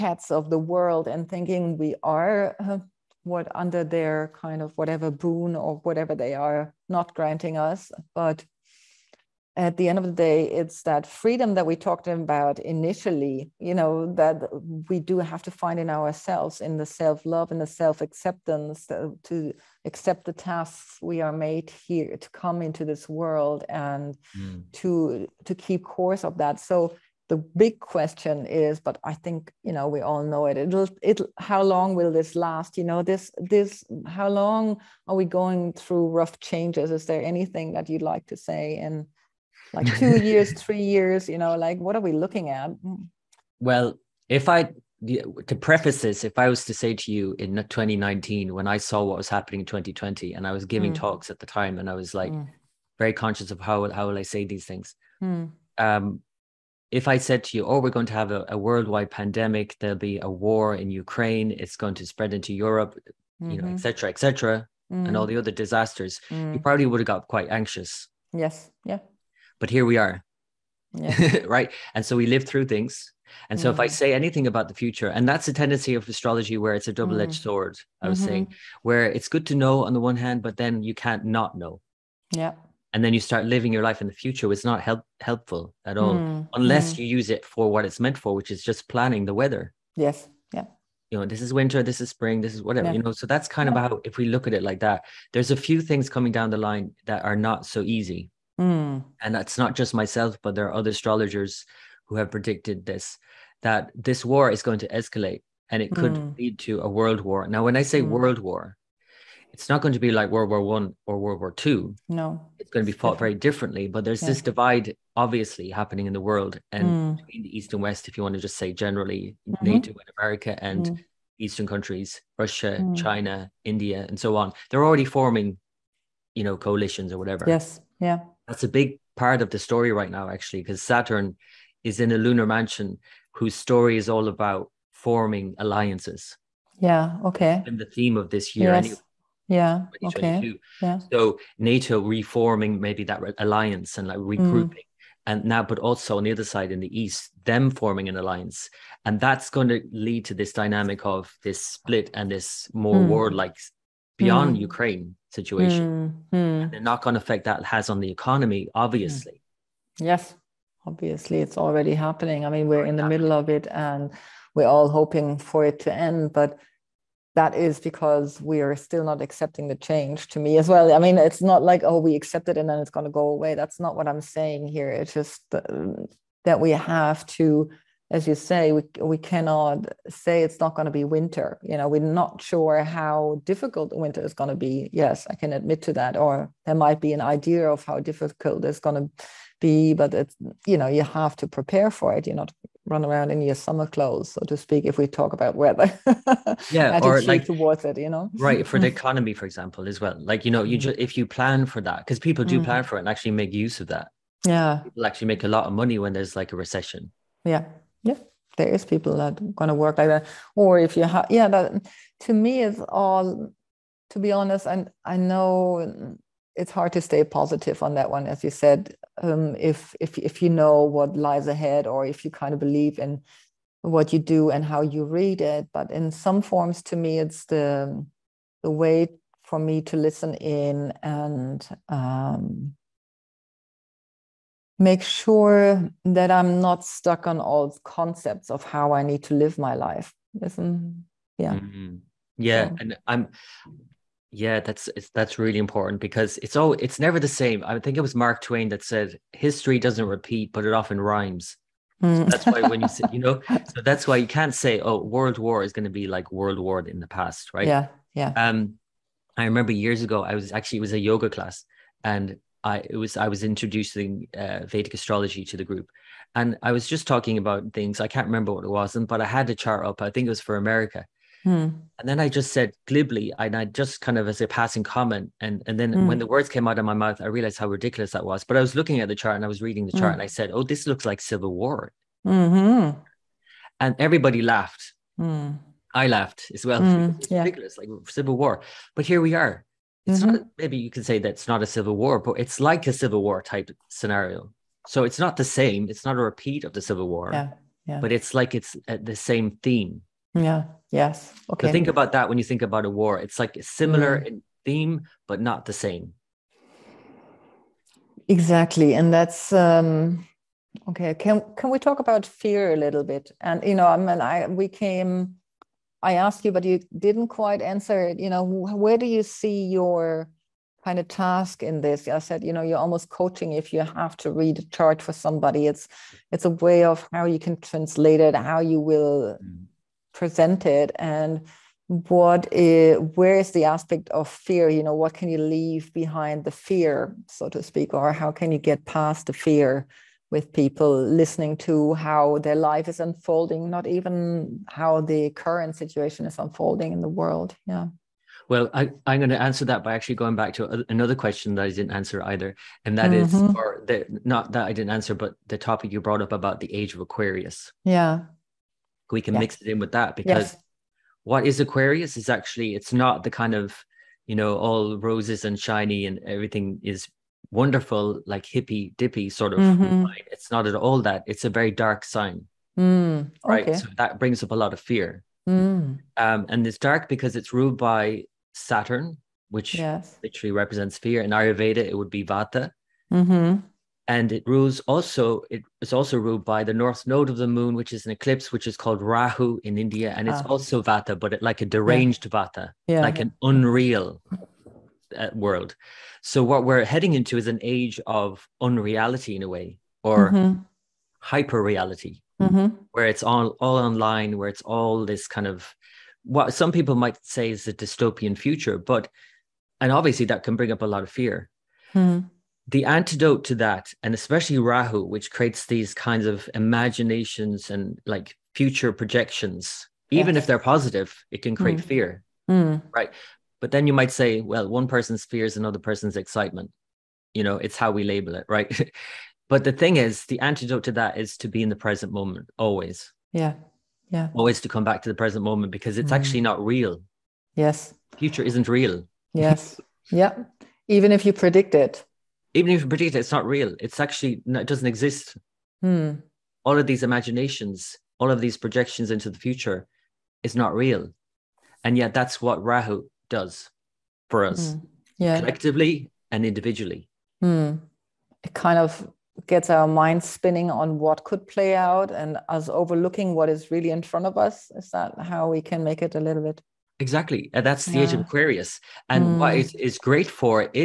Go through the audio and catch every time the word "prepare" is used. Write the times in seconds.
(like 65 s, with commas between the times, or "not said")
191 s.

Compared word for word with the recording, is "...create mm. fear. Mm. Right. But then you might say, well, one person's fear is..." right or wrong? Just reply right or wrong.
right.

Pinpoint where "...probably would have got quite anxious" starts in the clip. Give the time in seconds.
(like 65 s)
66 s.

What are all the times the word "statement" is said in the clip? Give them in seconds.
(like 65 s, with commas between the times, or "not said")
not said.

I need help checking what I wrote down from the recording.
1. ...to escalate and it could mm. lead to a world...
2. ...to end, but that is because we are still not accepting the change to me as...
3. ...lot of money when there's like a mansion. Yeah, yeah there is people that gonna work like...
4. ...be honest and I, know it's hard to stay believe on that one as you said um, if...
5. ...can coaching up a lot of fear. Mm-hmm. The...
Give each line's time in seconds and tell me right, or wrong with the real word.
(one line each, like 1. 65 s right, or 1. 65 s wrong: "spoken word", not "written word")
1. 104 s right
2. 165 s right
3. 205 s wrong: "recession", not "mansion"
4. 214 s wrong: "positive", not "believe"
5. 410 s wrong: "bring", not "coaching".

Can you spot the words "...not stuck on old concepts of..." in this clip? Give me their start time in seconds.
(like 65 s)
236 s.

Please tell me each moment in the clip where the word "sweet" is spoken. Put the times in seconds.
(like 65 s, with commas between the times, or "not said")
not said.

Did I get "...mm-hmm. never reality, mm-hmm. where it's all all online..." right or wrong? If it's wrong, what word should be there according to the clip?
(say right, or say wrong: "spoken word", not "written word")
wrong: "hyper", not "never".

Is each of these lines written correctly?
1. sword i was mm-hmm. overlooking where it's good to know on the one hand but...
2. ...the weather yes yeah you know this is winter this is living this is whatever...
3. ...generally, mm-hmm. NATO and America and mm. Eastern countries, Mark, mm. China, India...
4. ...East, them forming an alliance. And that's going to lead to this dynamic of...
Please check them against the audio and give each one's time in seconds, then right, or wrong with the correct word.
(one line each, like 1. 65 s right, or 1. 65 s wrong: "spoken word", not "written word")
1. 77 s wrong: "saying", not "overlooking"
2. 89 s wrong: "spring", not "living"
3. 118 s wrong: "Russia", not "Mark"
4. 147 s right.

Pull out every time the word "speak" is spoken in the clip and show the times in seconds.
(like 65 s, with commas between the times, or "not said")
194 s, 337 s.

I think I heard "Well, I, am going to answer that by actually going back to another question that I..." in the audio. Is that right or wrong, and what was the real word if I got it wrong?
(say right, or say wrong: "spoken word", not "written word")
right.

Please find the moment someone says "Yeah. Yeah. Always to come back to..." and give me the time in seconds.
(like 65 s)
433 s.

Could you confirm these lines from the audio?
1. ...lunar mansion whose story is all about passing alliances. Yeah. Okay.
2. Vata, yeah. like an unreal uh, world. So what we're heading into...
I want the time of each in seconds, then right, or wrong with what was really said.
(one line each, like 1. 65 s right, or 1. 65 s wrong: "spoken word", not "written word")
1. 132 s wrong: "forming", not "passing"
2. 392 s right.